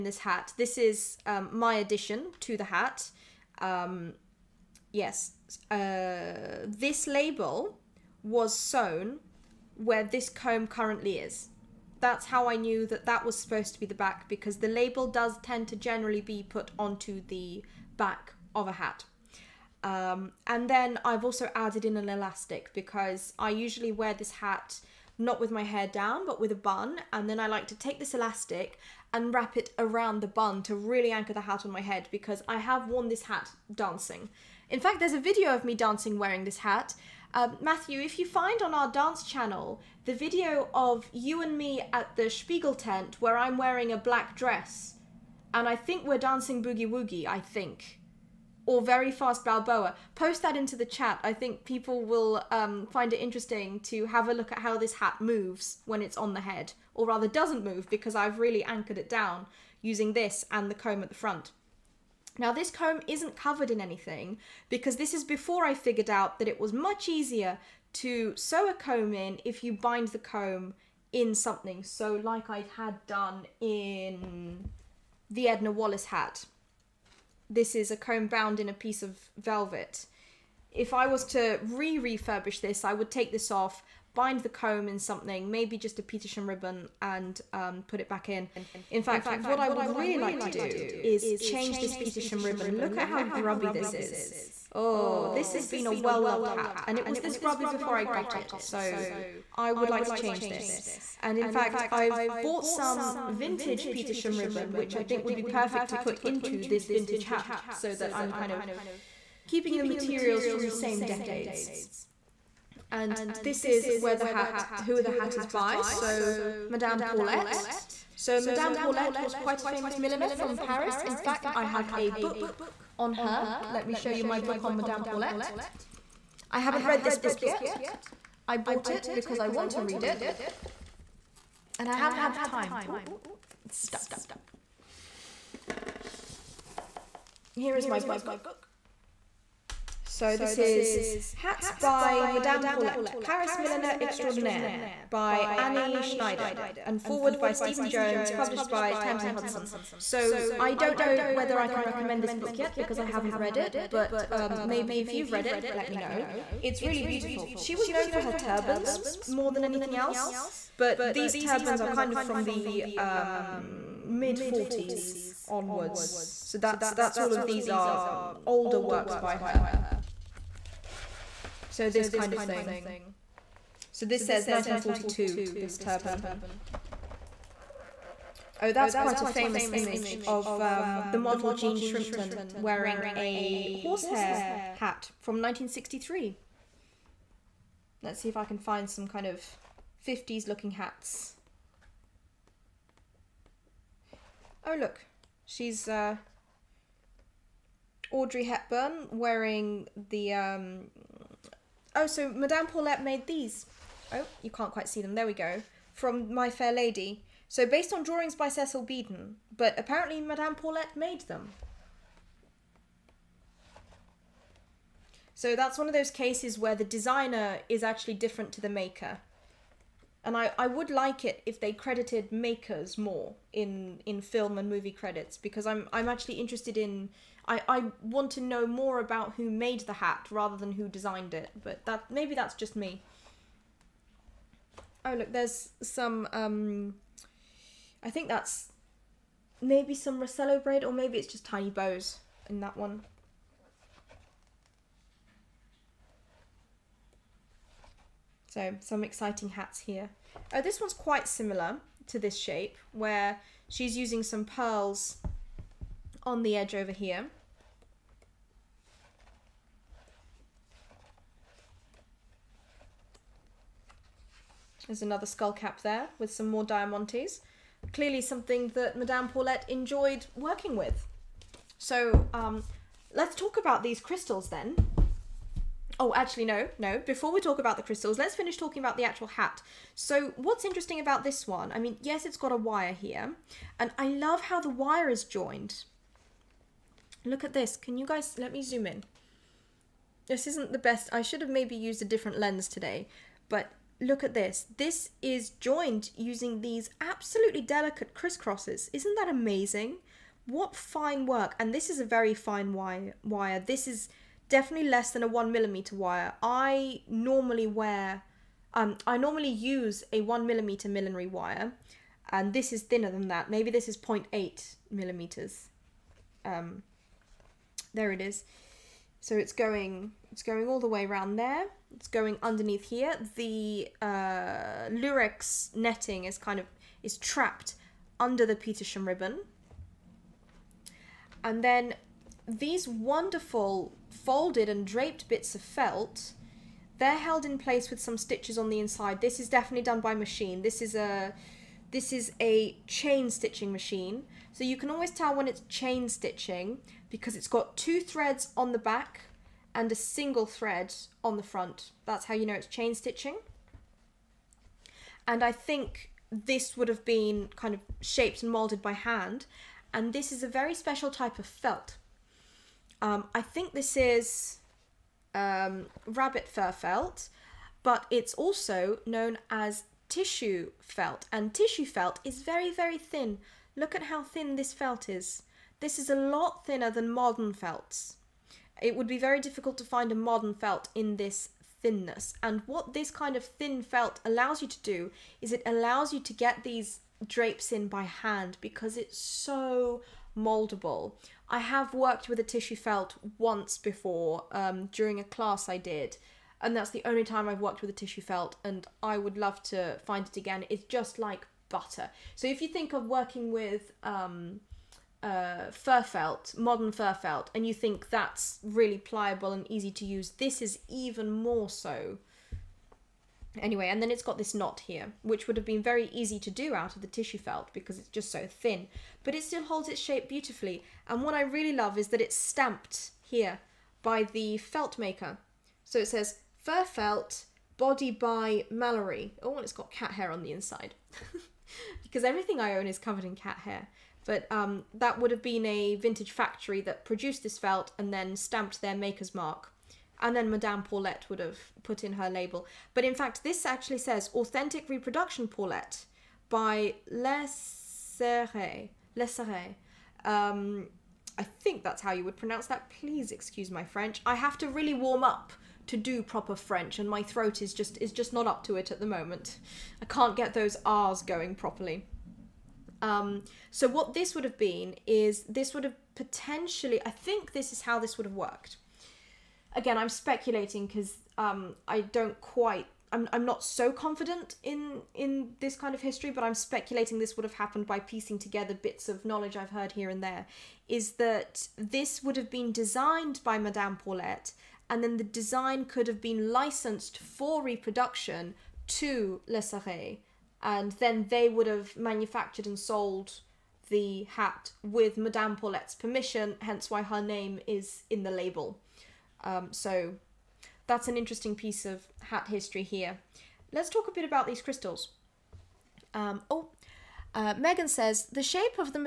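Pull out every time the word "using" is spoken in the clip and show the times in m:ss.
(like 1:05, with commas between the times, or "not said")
0:59, 4:13, 4:56.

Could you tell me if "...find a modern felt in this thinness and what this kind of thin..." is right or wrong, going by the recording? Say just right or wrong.
right.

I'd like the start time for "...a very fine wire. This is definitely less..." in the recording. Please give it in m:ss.
5:01.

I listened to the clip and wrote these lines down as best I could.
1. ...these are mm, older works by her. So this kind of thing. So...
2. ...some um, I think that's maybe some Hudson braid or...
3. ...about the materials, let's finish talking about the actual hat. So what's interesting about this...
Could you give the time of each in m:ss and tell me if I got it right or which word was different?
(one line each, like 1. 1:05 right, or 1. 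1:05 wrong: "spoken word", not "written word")
1. 2:47 right
2. 3:55 wrong: "Racello", not "Hudson"
3. 4:37 wrong: "crystals", not "materials".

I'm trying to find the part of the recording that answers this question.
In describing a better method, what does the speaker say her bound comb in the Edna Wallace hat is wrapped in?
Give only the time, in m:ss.
1:19.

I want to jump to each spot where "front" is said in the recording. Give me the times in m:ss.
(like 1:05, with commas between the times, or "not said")
1:01, 5:51.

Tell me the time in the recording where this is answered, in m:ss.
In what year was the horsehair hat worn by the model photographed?
3:05.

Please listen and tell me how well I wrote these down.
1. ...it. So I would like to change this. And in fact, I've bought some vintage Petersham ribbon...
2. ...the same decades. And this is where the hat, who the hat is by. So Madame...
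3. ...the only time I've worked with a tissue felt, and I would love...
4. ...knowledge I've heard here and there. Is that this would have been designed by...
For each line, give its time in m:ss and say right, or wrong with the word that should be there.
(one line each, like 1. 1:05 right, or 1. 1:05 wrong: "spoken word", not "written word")
1. 1:38 right
2. 1:50 right
3. 6:36 right
4. 7:59 right.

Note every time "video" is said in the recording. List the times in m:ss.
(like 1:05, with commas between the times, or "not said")
0:35, 0:40.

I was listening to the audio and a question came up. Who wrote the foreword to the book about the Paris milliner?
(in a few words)
Stephen Jones.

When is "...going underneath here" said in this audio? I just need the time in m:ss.
5:22.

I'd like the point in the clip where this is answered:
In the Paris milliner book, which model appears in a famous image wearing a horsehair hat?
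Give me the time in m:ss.
3:01.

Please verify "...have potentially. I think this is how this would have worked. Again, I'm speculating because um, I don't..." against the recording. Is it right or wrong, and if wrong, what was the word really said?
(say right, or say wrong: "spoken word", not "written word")
right.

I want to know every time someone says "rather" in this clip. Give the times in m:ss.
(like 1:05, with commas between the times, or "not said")
0:57, 3:50.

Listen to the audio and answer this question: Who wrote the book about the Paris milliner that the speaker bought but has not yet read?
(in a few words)
Annie Schneider.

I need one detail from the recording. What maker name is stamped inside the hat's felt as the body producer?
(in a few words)
Mallory.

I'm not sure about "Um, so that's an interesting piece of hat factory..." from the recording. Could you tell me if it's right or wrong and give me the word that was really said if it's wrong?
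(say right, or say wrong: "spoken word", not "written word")
wrong: "history", not "factory".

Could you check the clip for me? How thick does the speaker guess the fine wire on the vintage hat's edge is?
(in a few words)
0.8 millimeters.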